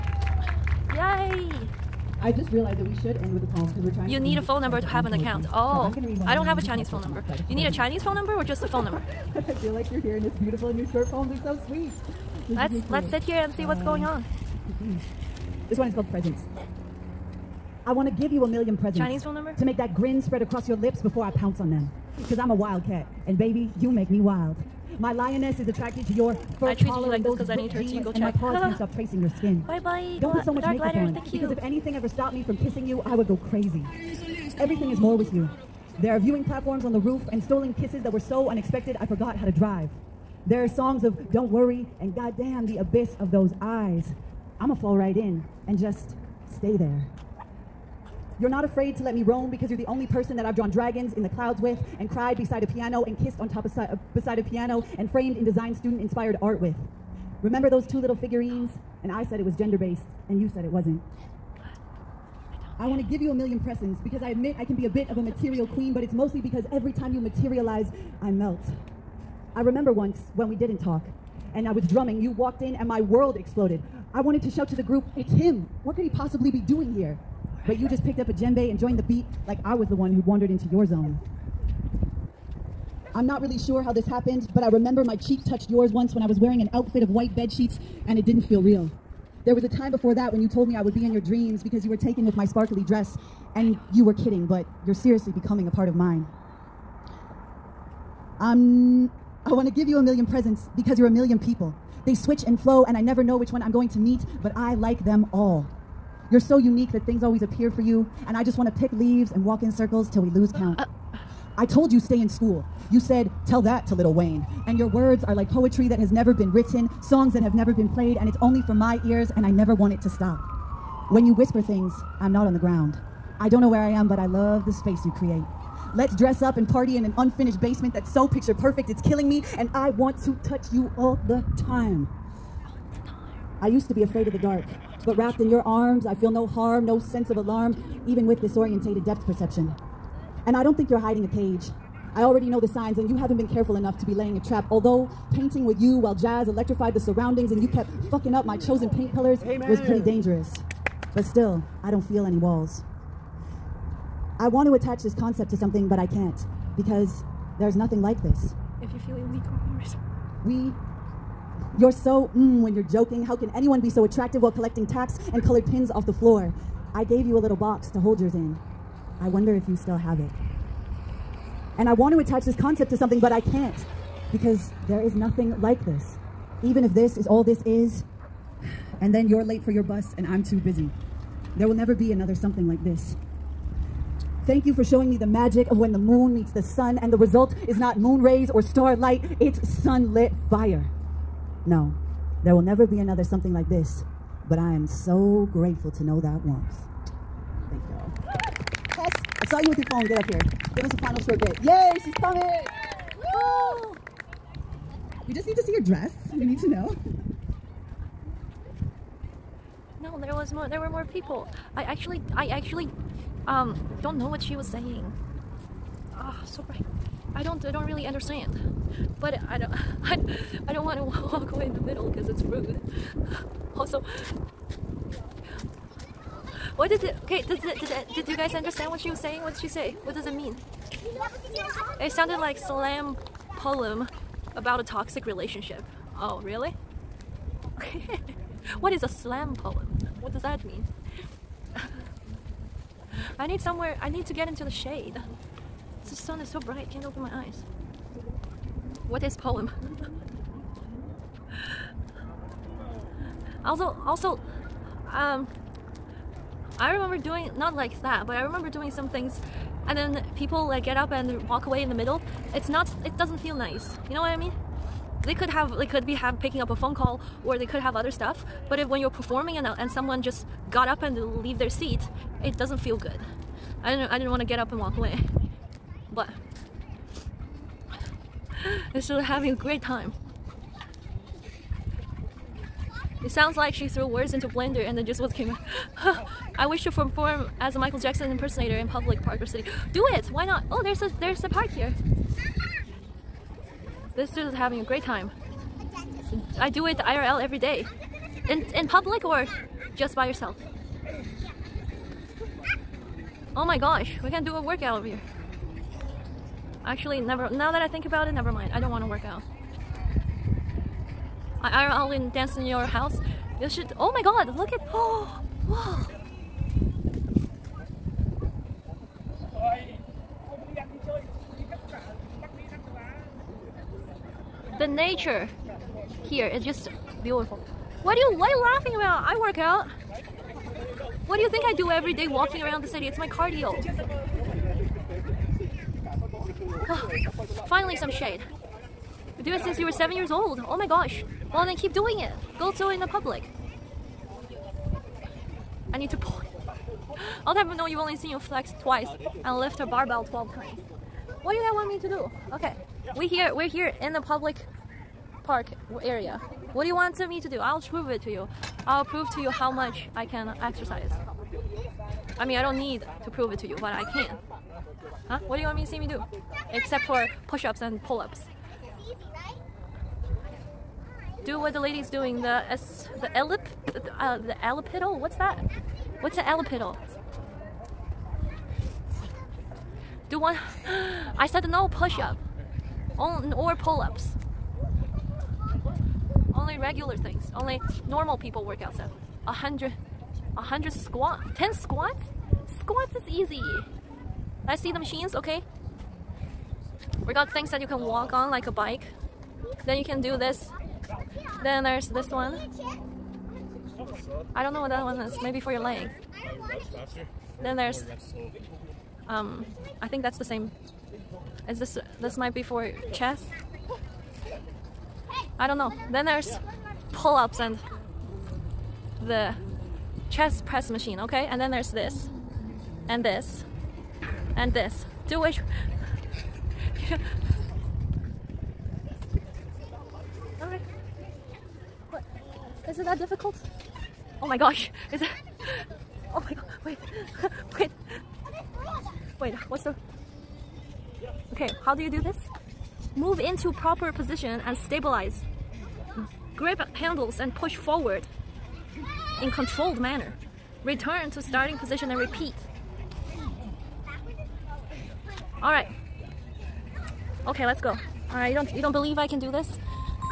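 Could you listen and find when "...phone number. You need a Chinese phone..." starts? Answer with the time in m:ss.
0:06.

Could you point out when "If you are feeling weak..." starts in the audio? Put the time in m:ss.
2:38.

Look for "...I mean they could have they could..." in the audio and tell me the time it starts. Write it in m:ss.
4:24.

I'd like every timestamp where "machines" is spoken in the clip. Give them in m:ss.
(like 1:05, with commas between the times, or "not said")
6:34, 7:00.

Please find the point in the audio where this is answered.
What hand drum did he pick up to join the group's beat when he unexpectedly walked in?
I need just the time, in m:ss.
1:18.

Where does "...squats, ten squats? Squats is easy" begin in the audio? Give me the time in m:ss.
6:30.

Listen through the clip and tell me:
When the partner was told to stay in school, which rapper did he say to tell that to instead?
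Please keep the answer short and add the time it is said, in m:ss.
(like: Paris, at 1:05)
Little Wayne, at 1:53.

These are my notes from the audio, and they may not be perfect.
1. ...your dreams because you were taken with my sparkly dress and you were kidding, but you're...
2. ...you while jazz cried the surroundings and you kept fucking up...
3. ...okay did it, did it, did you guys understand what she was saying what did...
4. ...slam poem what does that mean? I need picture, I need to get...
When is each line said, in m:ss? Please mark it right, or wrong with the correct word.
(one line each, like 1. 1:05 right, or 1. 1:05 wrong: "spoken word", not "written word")
1. 1:31 right
2. 2:25 wrong: "electrified", not "cried"
3. 3:47 right
4. 3:59 wrong: "somewhere", not "picture".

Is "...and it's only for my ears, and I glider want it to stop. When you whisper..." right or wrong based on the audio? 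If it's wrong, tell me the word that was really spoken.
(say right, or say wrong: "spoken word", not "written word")
wrong: "never", not "glider".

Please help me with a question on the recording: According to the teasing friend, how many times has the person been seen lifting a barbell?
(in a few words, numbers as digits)
12.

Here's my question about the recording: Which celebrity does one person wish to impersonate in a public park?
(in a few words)
Michael Jackson.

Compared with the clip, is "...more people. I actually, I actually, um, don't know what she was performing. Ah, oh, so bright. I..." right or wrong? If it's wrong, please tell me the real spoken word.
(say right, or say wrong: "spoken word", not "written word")
wrong: "saying", not "performing".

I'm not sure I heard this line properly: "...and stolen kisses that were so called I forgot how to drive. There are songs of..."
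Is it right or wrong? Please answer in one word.
wrong.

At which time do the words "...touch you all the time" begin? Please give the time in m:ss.
2:10.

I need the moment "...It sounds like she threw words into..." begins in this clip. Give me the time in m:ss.
4:43.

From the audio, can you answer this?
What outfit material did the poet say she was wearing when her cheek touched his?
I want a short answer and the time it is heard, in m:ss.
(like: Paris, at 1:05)
white bed sheets, at 1:27.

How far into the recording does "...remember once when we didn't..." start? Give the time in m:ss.
1:09.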